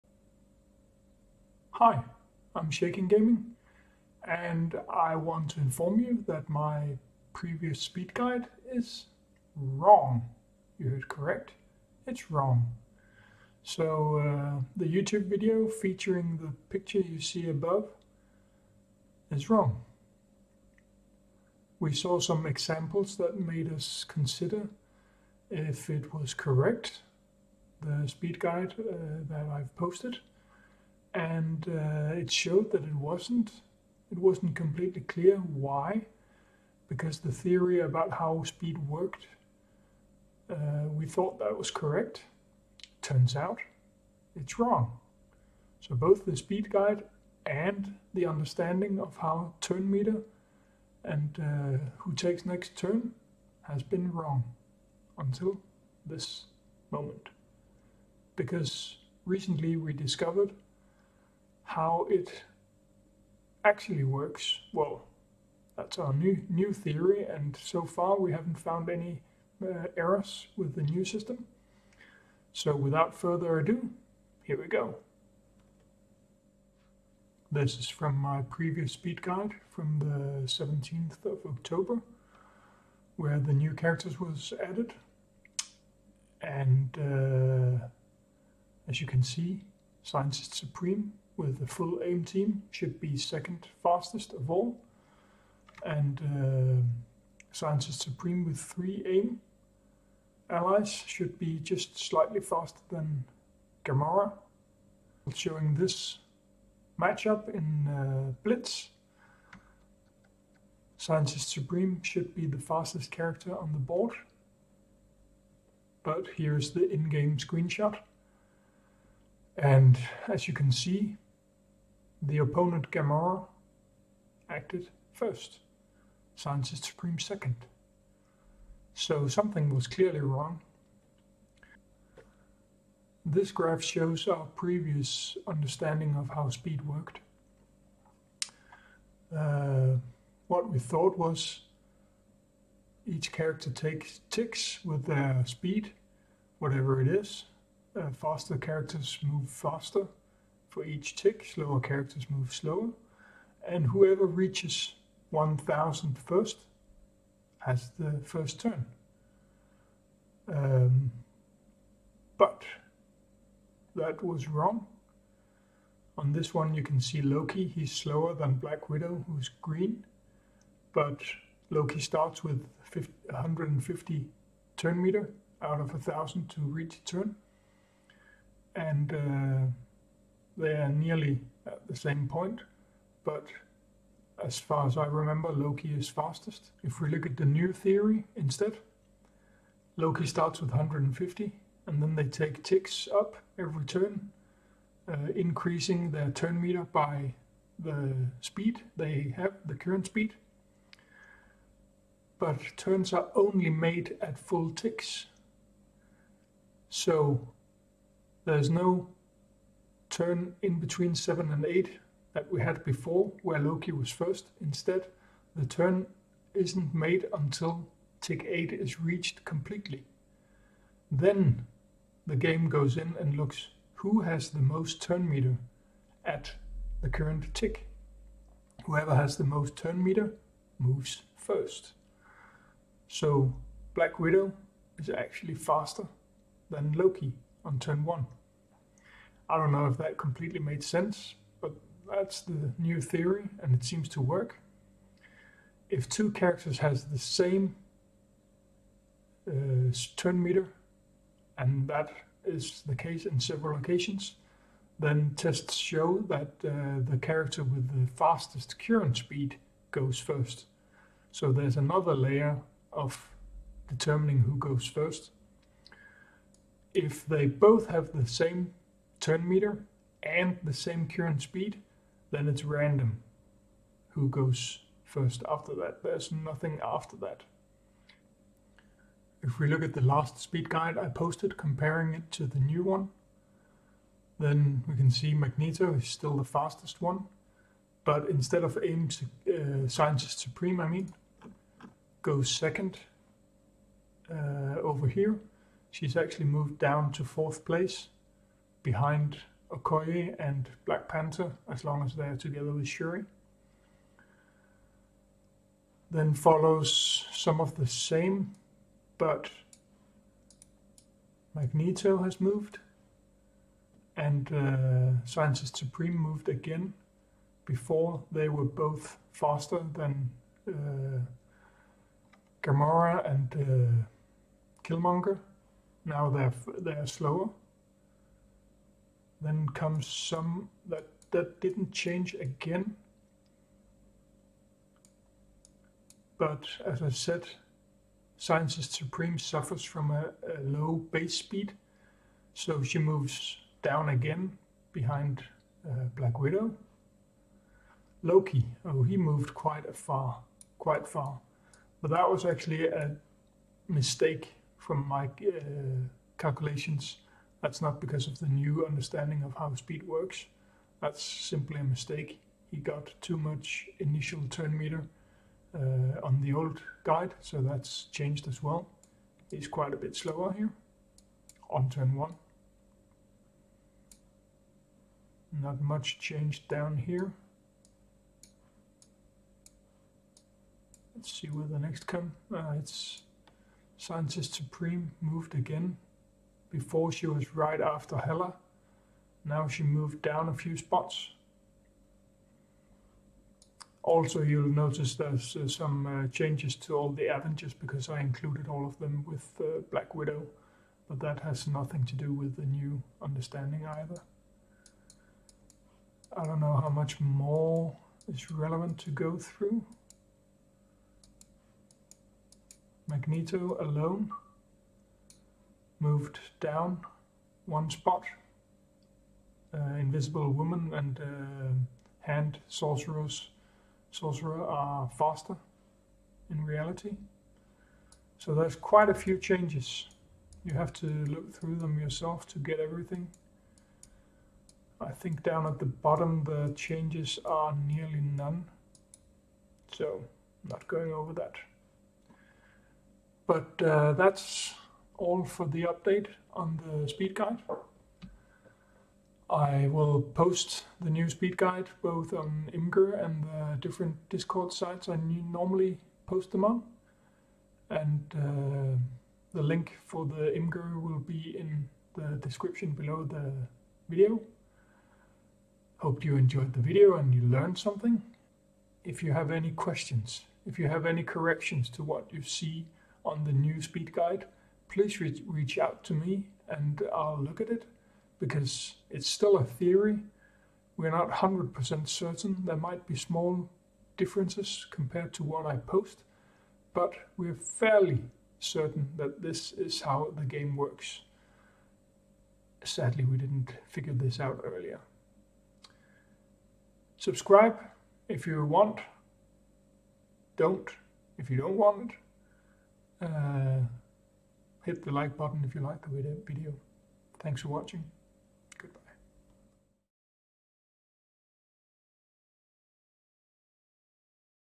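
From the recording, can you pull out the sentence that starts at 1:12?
So without further ado, here we go.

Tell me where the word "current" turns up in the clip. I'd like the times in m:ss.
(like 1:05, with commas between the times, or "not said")
3:19, 3:47, 4:18, 4:31.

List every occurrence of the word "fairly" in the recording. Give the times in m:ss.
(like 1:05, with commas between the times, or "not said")
8:07.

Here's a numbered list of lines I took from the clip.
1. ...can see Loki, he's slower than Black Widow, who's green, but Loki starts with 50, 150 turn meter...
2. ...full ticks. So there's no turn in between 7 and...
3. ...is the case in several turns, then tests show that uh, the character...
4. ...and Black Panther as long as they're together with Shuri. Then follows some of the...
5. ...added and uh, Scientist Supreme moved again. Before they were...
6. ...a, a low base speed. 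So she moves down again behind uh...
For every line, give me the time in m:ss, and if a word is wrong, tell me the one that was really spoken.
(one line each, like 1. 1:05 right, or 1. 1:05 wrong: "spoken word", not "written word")
1. 2:46 right
2. 3:24 right
3. 4:12 wrong: "occasions", not "turns"
4. 5:00 right
5. 5:12 wrong: "moved", not "added"
6. 5:40 right.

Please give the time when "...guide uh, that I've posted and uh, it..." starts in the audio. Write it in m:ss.
0:28.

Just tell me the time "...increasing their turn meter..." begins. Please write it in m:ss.
3:15.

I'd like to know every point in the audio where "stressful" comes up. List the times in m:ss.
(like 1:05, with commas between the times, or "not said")
not said.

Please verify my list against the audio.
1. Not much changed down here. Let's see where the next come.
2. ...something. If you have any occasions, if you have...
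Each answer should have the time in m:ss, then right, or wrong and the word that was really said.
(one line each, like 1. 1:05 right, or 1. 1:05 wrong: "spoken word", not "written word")
1. 6:15 right
2. 7:47 wrong: "questions", not "occasions".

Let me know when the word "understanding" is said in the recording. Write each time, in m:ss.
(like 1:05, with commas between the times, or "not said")
0:48, 2:15, 5:58, 6:43.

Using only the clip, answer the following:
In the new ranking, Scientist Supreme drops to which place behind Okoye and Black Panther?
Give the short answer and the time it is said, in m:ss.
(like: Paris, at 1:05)
Fourth place, at 4:57.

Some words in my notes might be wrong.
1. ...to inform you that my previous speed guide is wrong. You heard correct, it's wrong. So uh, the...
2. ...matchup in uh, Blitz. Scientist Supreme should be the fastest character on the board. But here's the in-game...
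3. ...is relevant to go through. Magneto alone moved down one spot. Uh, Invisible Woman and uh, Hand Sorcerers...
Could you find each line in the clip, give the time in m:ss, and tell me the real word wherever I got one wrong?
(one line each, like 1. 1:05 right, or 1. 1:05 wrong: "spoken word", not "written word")
1. 0:05 right
2. 1:46 right
3. 6:48 right.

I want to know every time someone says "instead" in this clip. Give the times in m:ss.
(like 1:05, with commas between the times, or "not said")
3:08, 3:34, 4:48.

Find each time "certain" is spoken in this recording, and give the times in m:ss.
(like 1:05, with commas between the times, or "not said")
8:02, 8:08.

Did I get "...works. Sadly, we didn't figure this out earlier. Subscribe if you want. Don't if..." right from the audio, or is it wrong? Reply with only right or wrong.
right.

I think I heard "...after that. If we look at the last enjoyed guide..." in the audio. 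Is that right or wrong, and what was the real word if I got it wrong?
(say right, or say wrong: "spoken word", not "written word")
wrong: "speed", not "enjoyed".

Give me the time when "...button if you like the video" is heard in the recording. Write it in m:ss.
8:25.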